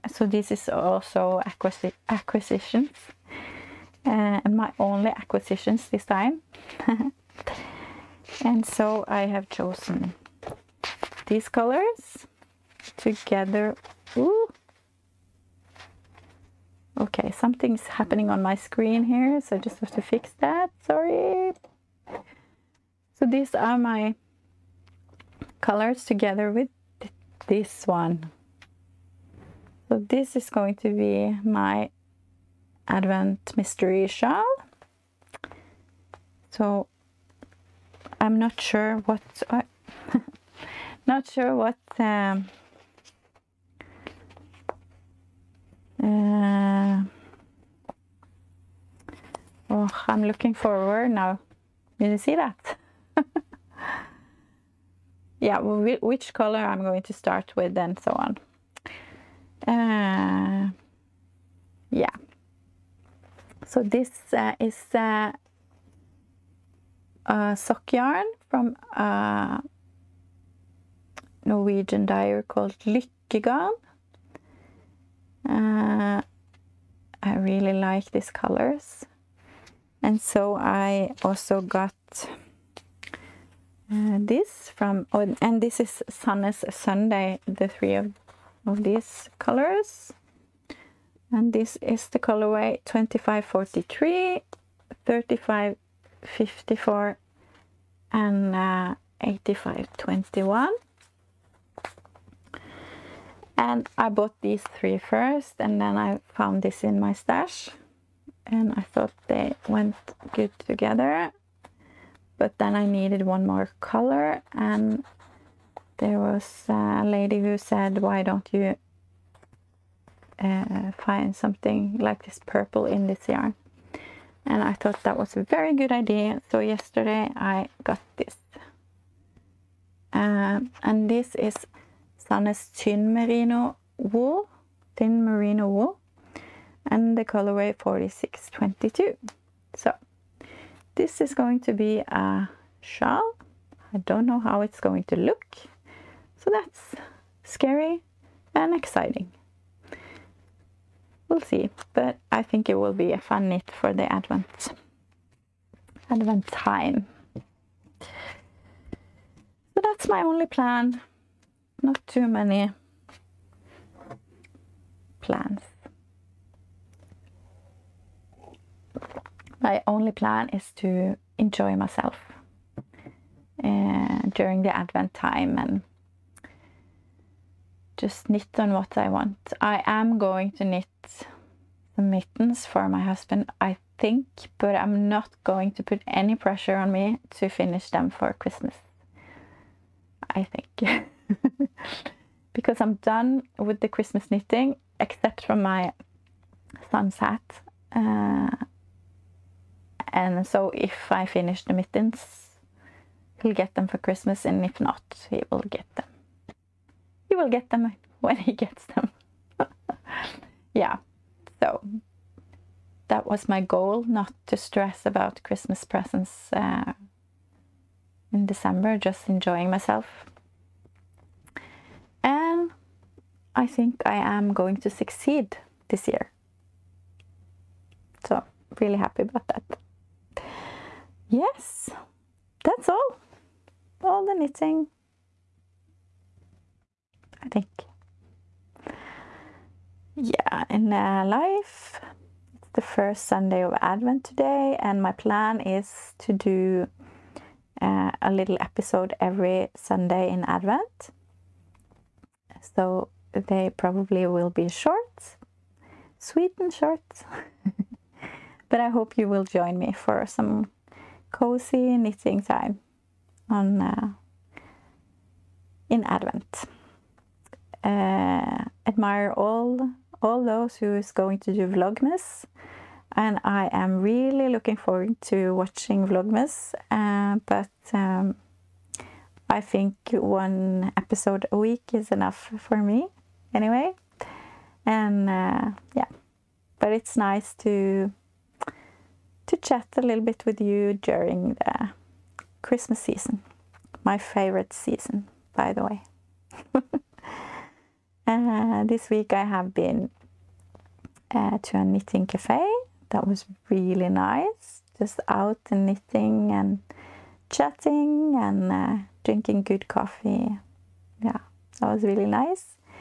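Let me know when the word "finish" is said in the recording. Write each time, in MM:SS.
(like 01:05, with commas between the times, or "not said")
03:07, 03:21.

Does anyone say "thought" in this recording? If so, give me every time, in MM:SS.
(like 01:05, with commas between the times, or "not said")
01:48, 02:04.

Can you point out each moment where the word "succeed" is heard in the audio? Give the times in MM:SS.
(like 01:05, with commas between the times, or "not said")
03:44.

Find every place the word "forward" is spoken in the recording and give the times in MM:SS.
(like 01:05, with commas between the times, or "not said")
00:50, 04:34.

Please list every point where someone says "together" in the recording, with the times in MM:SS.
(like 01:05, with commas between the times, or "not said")
00:12, 00:26, 01:50.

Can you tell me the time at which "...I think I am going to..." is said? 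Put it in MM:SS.
03:43.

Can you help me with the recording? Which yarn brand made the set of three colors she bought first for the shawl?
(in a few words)
Sandnes.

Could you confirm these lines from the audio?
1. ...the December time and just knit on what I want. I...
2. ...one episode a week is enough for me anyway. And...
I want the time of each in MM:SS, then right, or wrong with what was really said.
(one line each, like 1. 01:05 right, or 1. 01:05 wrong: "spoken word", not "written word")
1. 02:54 wrong: "Advent", not "December"
2. 04:40 right.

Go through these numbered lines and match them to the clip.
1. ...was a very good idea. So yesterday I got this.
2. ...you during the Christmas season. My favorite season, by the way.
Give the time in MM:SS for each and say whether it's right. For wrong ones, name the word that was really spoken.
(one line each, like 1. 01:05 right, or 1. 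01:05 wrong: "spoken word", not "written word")
1. 02:05 right
2. 04:50 right.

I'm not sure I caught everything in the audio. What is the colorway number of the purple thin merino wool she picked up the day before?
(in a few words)
4622.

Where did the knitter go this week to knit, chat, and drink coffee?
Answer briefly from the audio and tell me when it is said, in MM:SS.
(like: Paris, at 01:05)
A knitting cafe, at 05:01.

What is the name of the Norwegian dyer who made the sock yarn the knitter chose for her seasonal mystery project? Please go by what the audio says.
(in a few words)
Lykkegarn.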